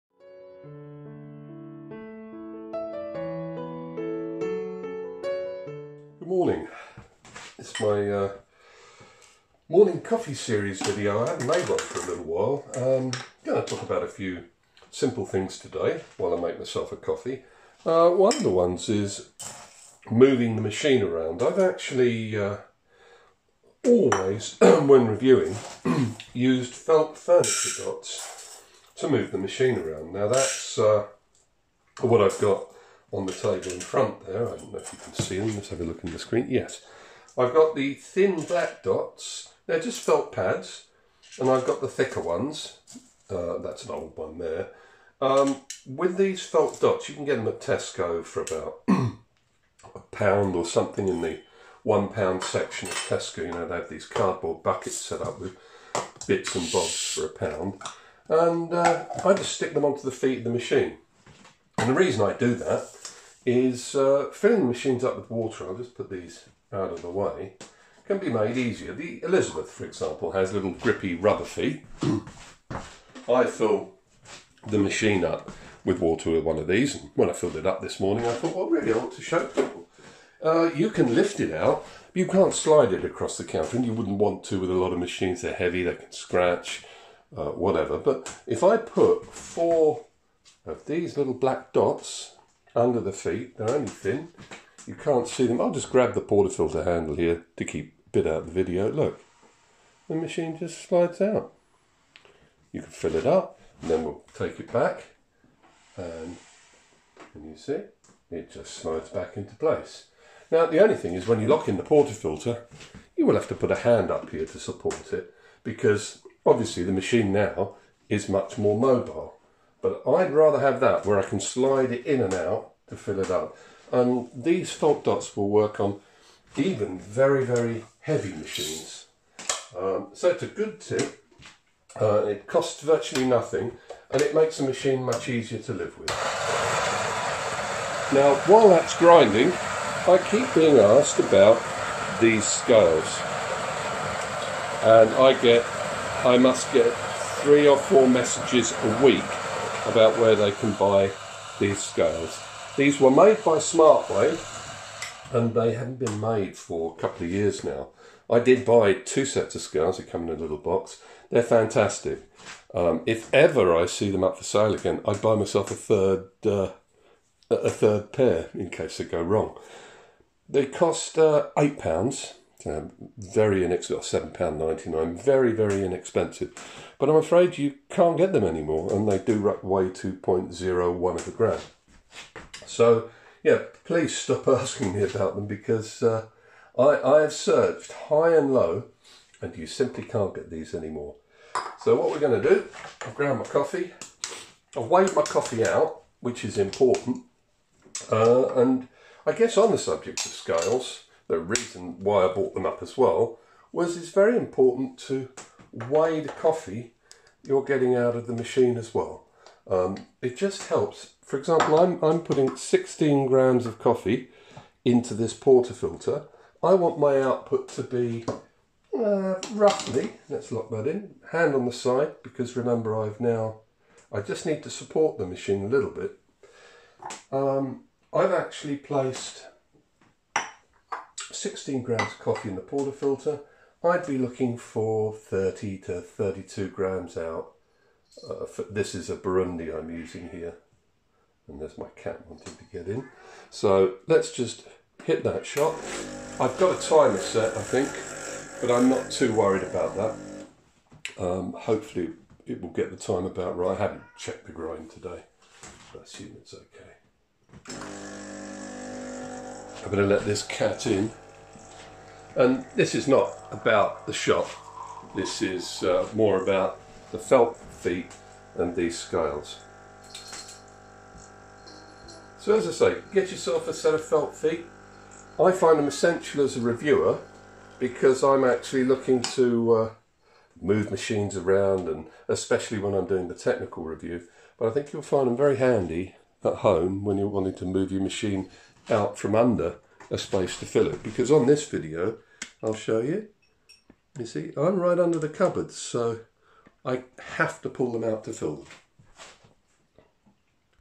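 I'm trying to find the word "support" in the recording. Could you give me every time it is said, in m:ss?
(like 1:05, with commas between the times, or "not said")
1:54, 3:44.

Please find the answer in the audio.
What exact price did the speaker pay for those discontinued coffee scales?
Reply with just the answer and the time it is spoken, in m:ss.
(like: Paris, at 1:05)
£7.99, at 2:54.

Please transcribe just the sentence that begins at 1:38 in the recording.
Look, the machine just slides out.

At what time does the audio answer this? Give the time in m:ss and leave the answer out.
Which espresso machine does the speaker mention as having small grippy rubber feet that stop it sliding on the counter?
1:09.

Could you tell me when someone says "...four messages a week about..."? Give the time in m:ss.
2:27.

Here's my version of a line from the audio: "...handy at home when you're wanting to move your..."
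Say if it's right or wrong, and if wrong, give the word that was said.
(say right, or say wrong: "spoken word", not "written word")
right.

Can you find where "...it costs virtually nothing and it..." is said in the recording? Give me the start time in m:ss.
2:12.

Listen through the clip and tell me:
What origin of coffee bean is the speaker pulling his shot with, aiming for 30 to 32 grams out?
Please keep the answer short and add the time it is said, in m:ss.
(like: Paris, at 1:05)
Burundi, at 3:59.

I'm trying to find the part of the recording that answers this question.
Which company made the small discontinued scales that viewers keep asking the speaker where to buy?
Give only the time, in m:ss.
2:33.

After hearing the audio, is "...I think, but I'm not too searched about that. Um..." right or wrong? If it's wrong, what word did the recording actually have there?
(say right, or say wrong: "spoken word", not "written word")
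wrong: "worried", not "searched".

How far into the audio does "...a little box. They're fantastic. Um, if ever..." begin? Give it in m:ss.
2:40.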